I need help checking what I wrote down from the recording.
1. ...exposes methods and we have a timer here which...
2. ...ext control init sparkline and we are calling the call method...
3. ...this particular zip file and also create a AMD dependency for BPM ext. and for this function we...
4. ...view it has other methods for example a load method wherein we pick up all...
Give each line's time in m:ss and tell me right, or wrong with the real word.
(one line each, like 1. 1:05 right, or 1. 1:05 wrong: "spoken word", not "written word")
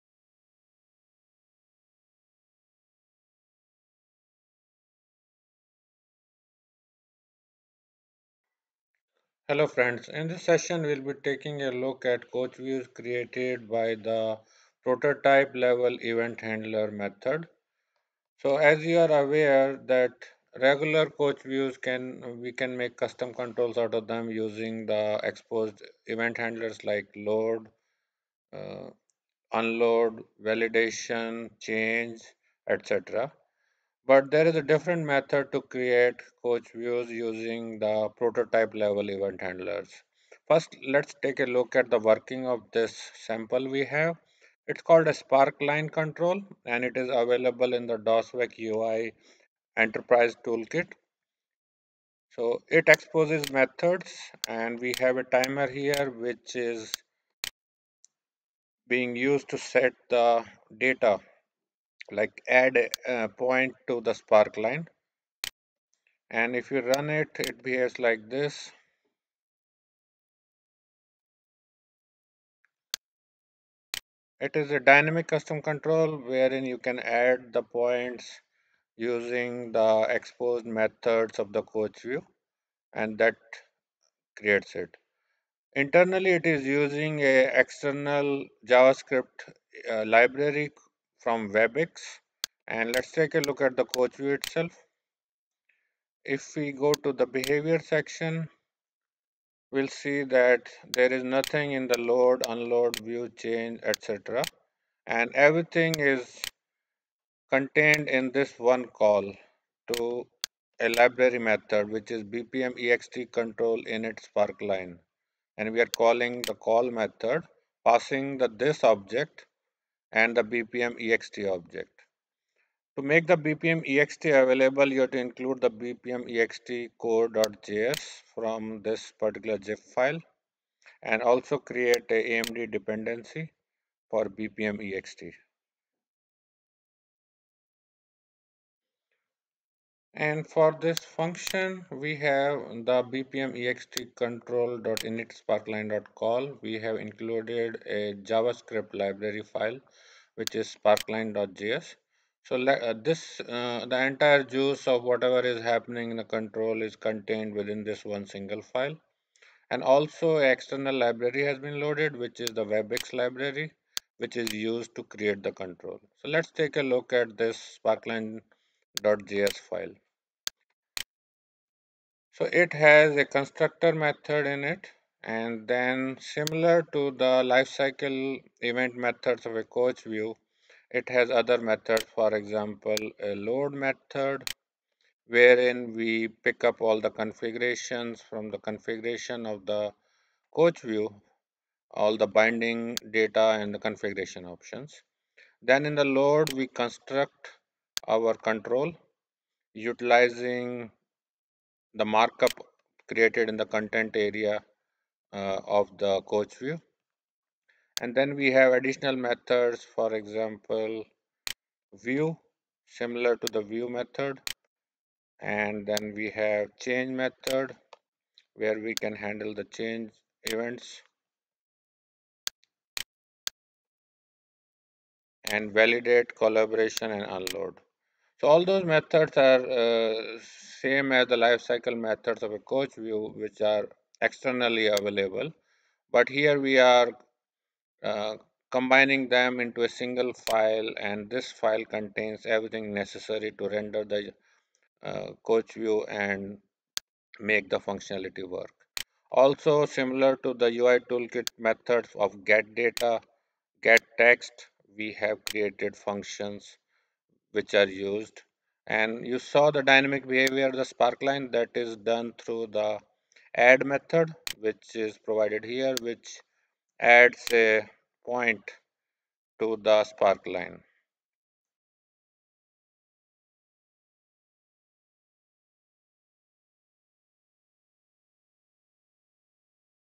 1. 0:52 right
2. 1:52 right
3. 2:08 right
4. 3:00 right.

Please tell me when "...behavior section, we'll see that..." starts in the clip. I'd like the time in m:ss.
1:37.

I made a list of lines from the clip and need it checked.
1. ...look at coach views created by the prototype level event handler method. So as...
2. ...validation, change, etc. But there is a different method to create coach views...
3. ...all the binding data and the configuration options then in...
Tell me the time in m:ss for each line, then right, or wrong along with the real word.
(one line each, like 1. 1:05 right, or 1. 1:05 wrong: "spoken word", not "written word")
1. 0:11 right
2. 0:30 right
3. 3:11 right.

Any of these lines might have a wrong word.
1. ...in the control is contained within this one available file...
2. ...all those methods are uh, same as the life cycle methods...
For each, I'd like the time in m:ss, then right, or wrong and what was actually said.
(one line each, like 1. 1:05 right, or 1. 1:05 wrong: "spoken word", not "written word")
1. 2:36 wrong: "single", not "available"
2. 3:48 right.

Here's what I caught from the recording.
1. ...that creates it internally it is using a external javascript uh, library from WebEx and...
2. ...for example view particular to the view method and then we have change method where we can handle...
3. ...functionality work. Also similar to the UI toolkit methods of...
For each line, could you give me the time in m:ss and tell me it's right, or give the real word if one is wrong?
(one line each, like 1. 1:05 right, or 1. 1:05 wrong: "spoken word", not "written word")
1. 1:23 right
2. 3:29 wrong: "similar", not "particular"
3. 4:07 right.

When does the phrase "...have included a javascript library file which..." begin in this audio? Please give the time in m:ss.
2:26.